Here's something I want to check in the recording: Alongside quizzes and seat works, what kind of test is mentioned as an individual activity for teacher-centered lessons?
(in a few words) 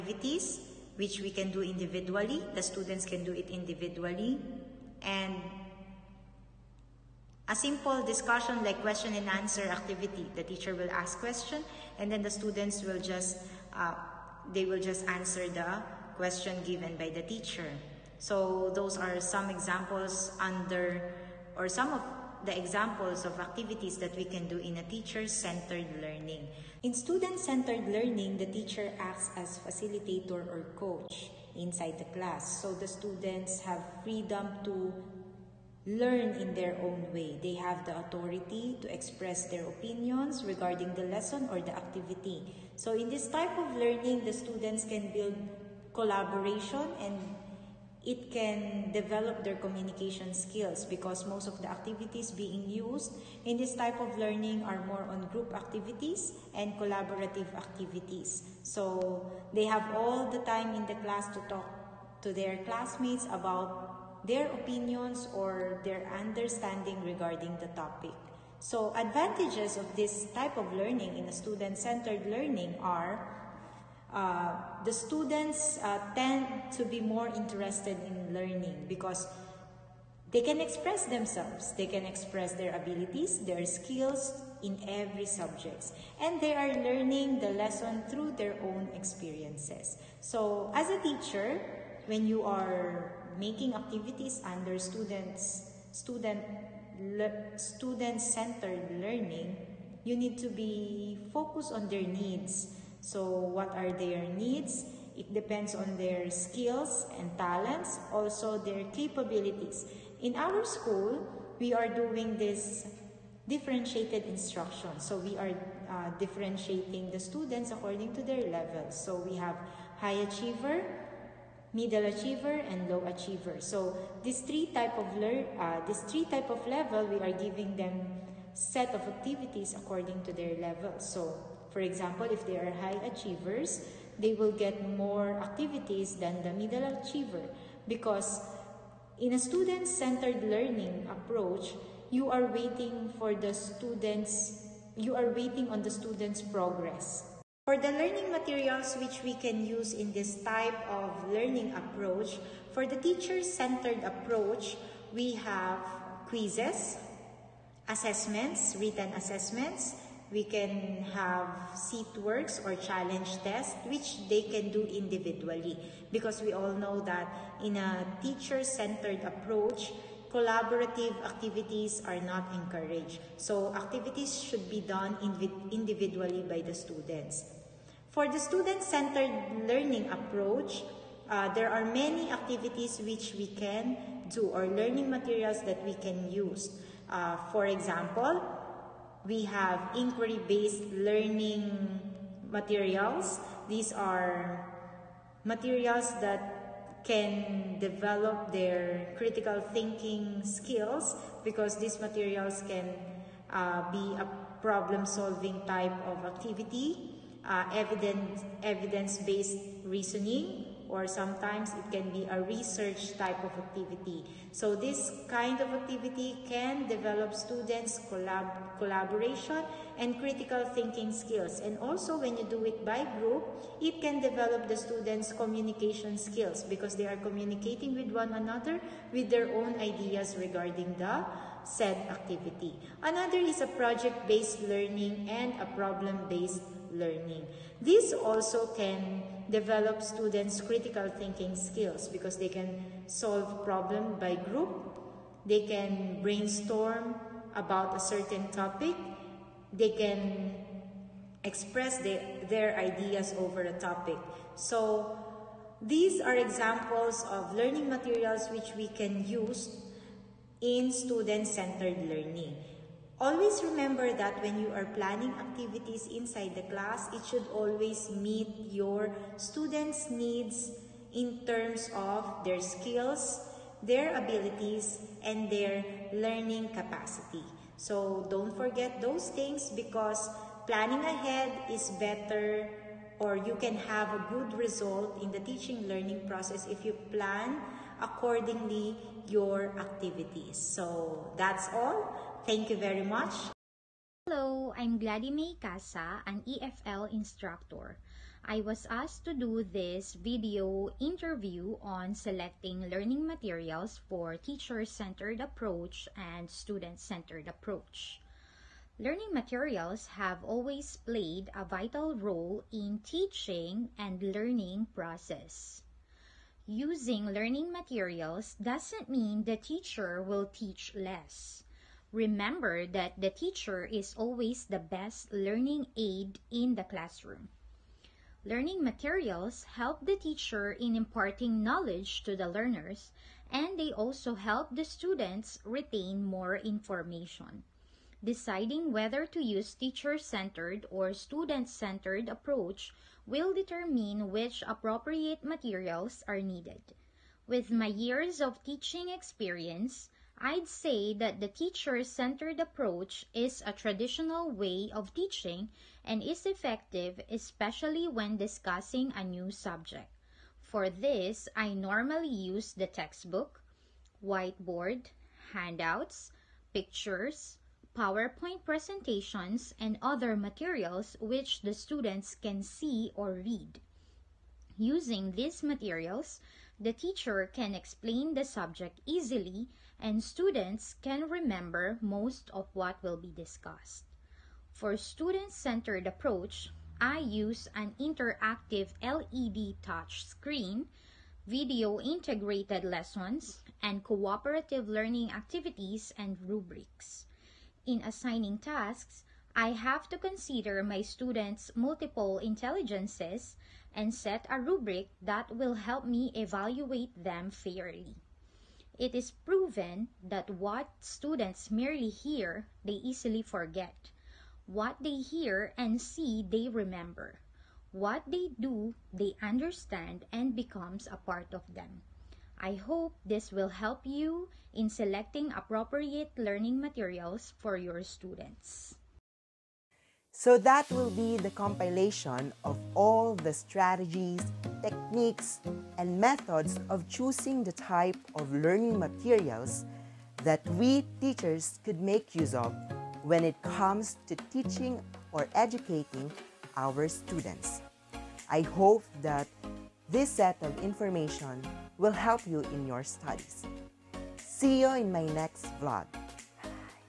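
challenge tests.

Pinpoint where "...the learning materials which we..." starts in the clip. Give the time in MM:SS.
02:27.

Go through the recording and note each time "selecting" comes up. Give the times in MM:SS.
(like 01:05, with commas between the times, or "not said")
05:02, 07:04.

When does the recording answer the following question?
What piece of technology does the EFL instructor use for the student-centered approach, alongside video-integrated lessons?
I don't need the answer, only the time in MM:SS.
06:27.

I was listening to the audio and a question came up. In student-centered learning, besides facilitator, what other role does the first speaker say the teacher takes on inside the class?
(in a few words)
coach.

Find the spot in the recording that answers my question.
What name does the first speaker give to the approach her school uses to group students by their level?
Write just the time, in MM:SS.
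01:53.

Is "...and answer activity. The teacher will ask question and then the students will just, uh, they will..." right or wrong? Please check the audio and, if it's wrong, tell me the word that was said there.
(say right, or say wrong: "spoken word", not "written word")
right.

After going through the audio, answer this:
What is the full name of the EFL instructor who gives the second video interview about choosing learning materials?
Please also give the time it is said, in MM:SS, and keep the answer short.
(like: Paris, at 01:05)
Gladys May Casa, at 04:55.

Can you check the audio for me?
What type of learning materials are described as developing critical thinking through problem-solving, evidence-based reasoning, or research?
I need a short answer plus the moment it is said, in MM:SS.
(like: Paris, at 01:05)
inquiry-based learning materials, at 03:09.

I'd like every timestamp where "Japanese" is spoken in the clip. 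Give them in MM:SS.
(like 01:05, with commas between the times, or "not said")
not said.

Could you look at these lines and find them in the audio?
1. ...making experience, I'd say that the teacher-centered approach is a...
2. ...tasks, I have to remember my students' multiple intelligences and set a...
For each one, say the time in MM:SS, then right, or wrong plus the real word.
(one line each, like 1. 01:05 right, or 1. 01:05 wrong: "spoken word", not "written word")
1. 05:48 wrong: "teaching", not "making"
2. 06:38 wrong: "consider", not "remember".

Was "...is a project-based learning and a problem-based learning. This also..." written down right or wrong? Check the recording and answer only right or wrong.
right.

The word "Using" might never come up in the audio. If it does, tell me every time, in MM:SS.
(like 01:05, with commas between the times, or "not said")
05:16, 06:14.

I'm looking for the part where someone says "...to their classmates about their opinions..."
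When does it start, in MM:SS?
01:02.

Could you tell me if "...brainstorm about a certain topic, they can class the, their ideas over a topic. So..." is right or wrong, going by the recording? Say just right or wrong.
wrong.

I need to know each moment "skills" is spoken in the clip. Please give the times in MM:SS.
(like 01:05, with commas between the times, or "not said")
00:50, 01:23, 01:46, 03:20, 03:41, 03:46, 04:01, 04:32.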